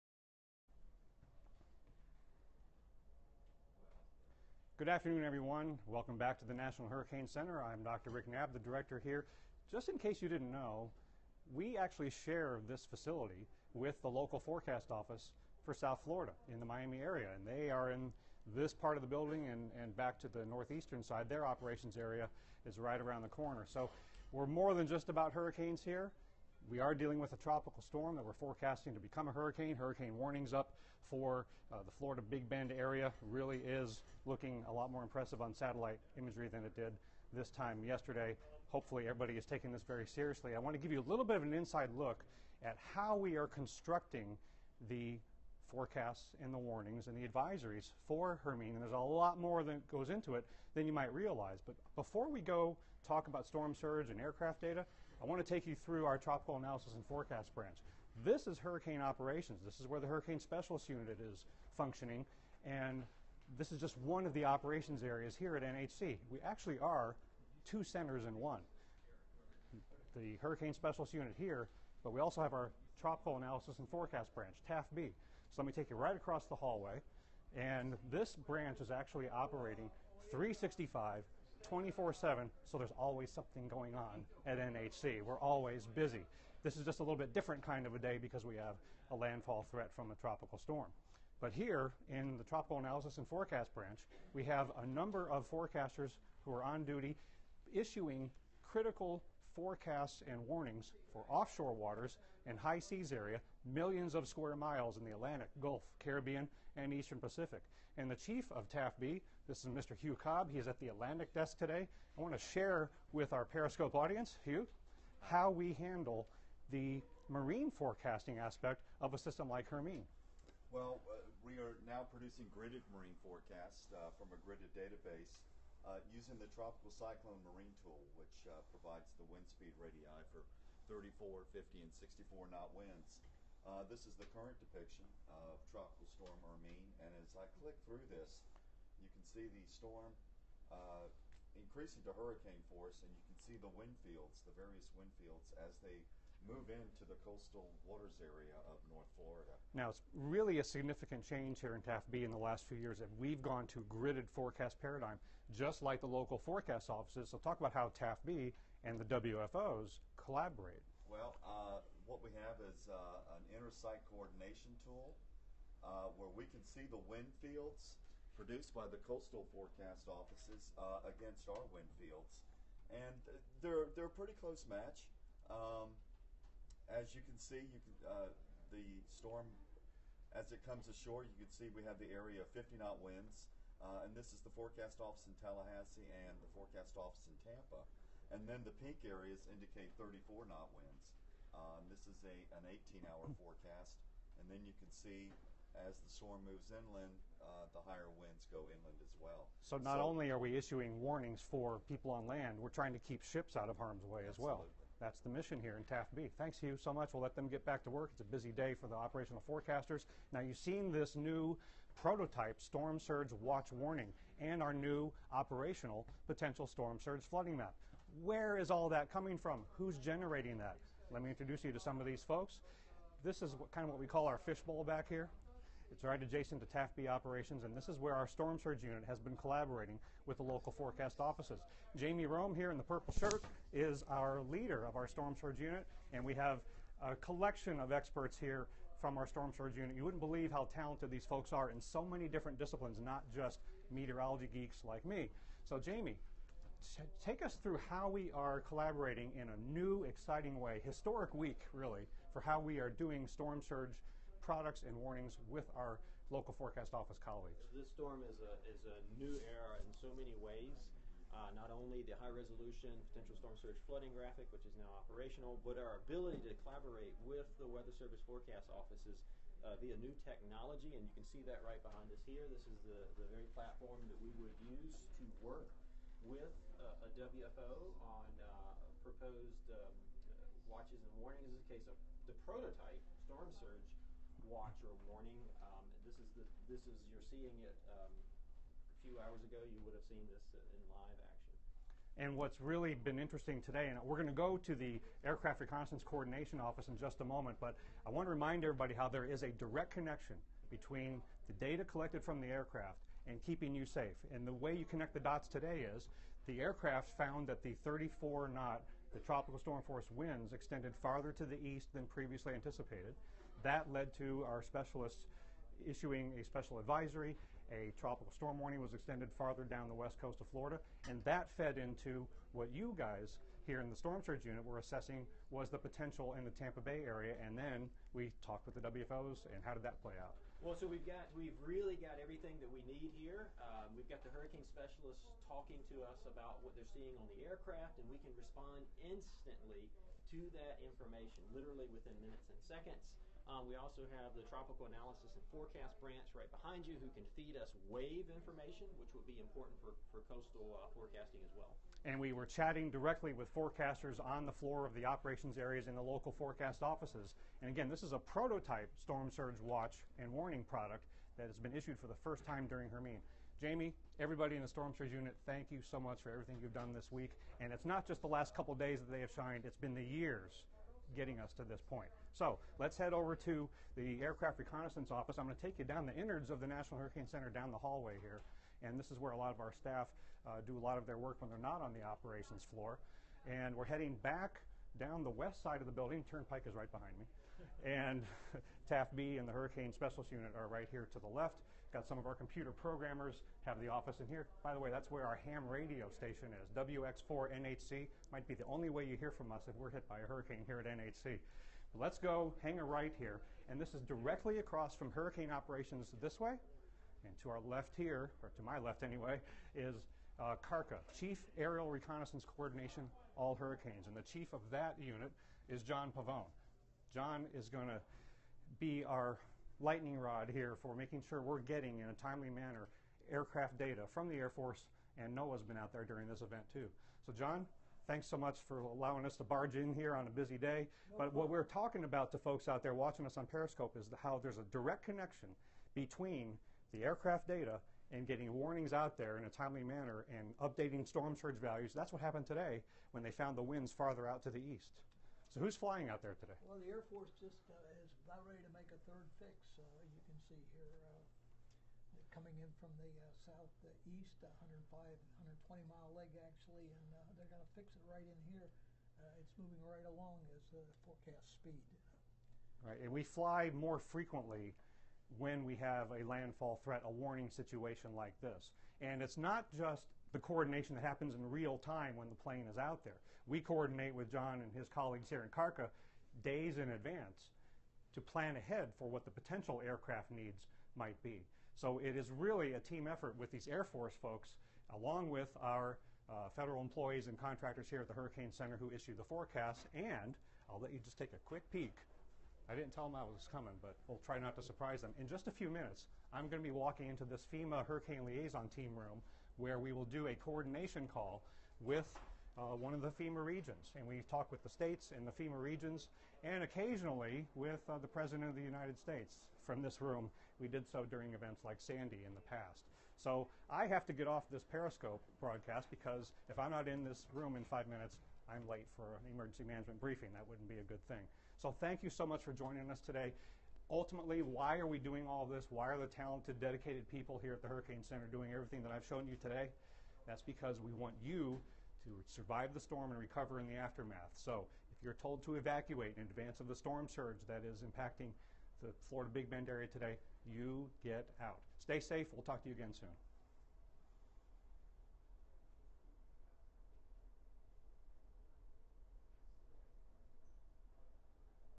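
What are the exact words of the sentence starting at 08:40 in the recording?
That wouldn't be a good thing.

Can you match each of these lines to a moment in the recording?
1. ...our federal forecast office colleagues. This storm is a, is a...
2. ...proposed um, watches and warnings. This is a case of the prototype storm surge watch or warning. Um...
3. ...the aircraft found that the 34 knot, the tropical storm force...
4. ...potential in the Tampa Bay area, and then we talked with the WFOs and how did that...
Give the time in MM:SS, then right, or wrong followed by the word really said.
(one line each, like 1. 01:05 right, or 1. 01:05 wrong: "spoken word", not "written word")
1. 04:15 wrong: "local", not "federal"
2. 04:39 right
3. 05:06 right
4. 05:25 right.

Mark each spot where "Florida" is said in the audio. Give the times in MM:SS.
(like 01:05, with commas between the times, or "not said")
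00:16, 00:31, 02:29, 05:20, 08:59.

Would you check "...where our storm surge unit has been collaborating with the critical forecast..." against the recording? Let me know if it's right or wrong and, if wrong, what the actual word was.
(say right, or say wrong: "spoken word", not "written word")
wrong: "local", not "critical".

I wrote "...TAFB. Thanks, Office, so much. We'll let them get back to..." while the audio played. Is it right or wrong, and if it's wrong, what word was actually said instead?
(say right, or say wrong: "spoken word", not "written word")
wrong: "Hugh", not "Office".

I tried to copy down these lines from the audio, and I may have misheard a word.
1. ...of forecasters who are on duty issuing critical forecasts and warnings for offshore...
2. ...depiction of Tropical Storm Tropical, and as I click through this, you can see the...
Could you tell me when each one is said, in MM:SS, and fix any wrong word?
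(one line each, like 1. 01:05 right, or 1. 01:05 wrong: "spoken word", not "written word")
1. 01:35 right
2. 02:14 wrong: "Hermine", not "Tropical".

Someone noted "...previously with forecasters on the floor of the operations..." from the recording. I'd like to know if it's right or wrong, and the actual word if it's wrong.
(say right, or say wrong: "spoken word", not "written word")
wrong: "directly", not "previously".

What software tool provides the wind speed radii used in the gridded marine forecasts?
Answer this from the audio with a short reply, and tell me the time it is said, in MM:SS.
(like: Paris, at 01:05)
Tropical Cyclone Marine Tool, at 02:06.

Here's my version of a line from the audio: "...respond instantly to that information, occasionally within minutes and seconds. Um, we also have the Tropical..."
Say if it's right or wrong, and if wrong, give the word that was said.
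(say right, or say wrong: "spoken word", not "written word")
wrong: "literally", not "occasionally".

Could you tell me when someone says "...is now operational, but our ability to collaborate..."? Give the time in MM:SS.
04:24.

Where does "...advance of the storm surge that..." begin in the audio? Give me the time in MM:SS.
08:56.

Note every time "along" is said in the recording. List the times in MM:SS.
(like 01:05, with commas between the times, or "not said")
07:40, 08:04.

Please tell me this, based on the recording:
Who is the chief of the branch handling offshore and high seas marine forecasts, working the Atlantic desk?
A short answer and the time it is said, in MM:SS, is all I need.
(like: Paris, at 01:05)
Hugh Cobb, at 01:50.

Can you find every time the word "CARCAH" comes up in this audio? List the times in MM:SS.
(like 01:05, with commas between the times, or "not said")
06:50, 07:55.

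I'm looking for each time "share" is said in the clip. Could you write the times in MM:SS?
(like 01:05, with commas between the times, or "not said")
00:12, 01:52.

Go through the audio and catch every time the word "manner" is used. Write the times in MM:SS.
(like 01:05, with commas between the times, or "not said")
07:02, 07:19.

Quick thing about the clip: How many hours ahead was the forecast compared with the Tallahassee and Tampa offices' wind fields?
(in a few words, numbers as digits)
18.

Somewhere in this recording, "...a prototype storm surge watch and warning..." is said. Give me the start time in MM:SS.
05:58.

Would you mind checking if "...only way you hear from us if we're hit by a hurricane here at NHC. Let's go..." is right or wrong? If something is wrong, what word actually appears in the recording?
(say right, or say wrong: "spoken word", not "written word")
right.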